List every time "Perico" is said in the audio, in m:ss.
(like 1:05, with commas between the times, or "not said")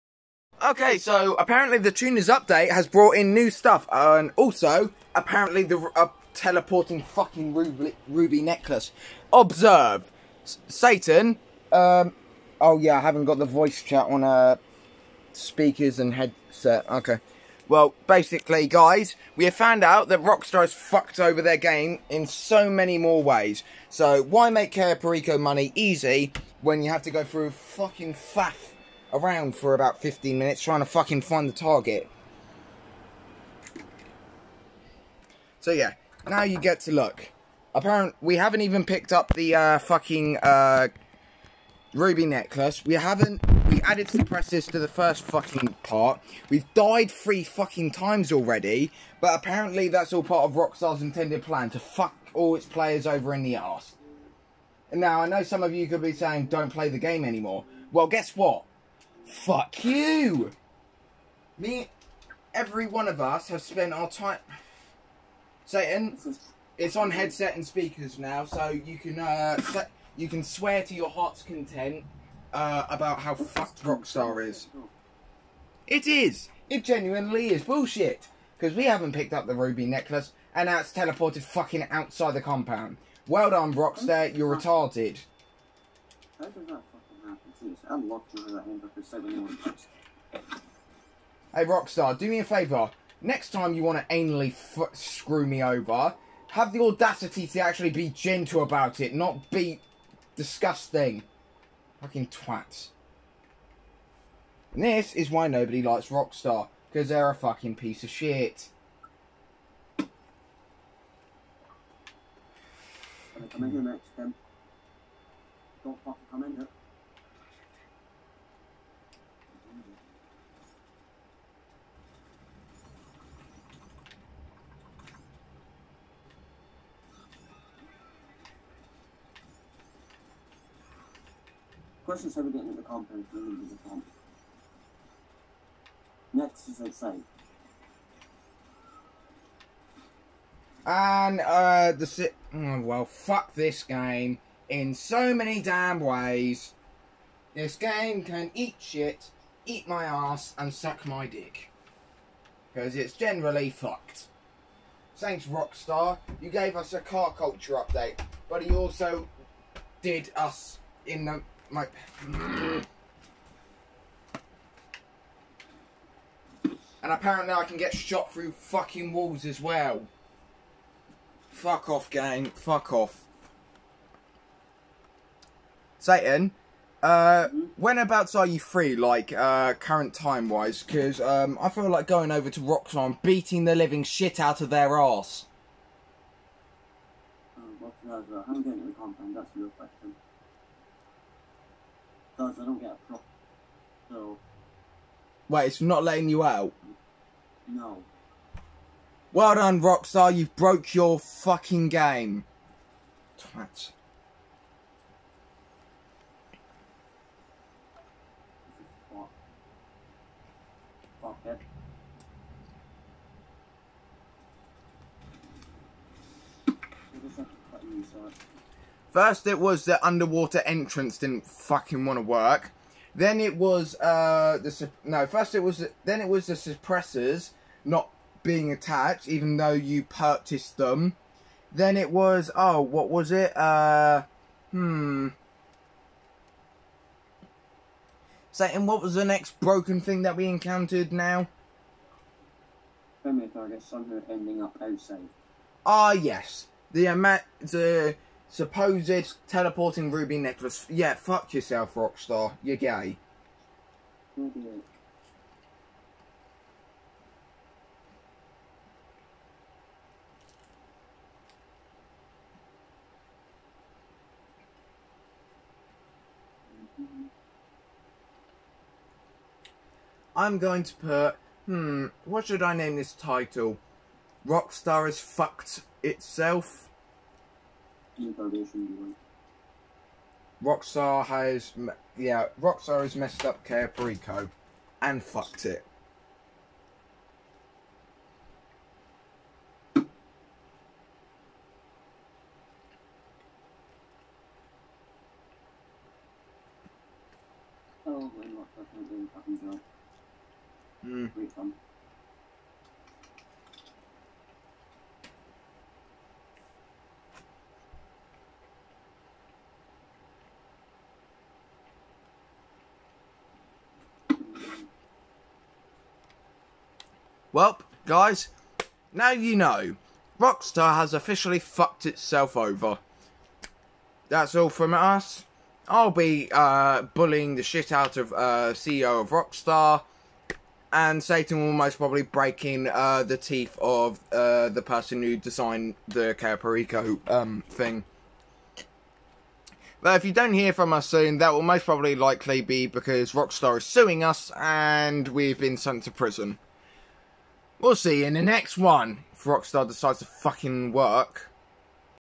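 0:24, 5:36.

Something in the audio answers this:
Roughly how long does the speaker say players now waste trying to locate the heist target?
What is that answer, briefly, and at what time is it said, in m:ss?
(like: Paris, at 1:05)
15 minutes, at 0:30.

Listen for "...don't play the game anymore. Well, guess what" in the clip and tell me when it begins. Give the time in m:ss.
0:56.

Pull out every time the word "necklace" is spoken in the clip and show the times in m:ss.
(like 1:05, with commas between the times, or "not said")
0:08, 0:42, 1:19, 4:10.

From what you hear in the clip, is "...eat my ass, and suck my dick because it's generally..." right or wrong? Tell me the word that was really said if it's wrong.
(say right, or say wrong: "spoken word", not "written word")
right.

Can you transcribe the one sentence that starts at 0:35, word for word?
So yeah, now you get to look.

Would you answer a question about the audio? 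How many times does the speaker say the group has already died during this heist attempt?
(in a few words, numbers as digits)
3.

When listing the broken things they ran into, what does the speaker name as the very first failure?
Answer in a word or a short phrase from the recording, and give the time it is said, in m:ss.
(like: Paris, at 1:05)
the underwater entrance, at 3:40.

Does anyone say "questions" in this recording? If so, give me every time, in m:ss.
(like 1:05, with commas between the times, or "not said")
2:12, 3:09.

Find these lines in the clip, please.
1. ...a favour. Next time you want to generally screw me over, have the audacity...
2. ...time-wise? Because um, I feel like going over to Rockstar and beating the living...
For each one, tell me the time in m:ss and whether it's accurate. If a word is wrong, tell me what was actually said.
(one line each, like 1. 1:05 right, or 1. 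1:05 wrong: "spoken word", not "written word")
1. 1:32 wrong: "anally", not "generally"
2. 3:00 right.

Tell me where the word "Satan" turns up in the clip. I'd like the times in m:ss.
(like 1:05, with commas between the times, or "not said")
0:10, 1:05, 2:55, 3:58, 5:31.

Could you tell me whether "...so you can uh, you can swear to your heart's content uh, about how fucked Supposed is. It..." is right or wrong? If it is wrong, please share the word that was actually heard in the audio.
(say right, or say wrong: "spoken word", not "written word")
wrong: "Rockstar", not "Supposed".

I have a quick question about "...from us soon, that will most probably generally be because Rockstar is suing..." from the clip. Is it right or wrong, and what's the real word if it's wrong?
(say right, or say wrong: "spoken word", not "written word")
wrong: "likely", not "generally".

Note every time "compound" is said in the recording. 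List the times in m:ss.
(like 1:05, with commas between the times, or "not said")
1:22, 2:12.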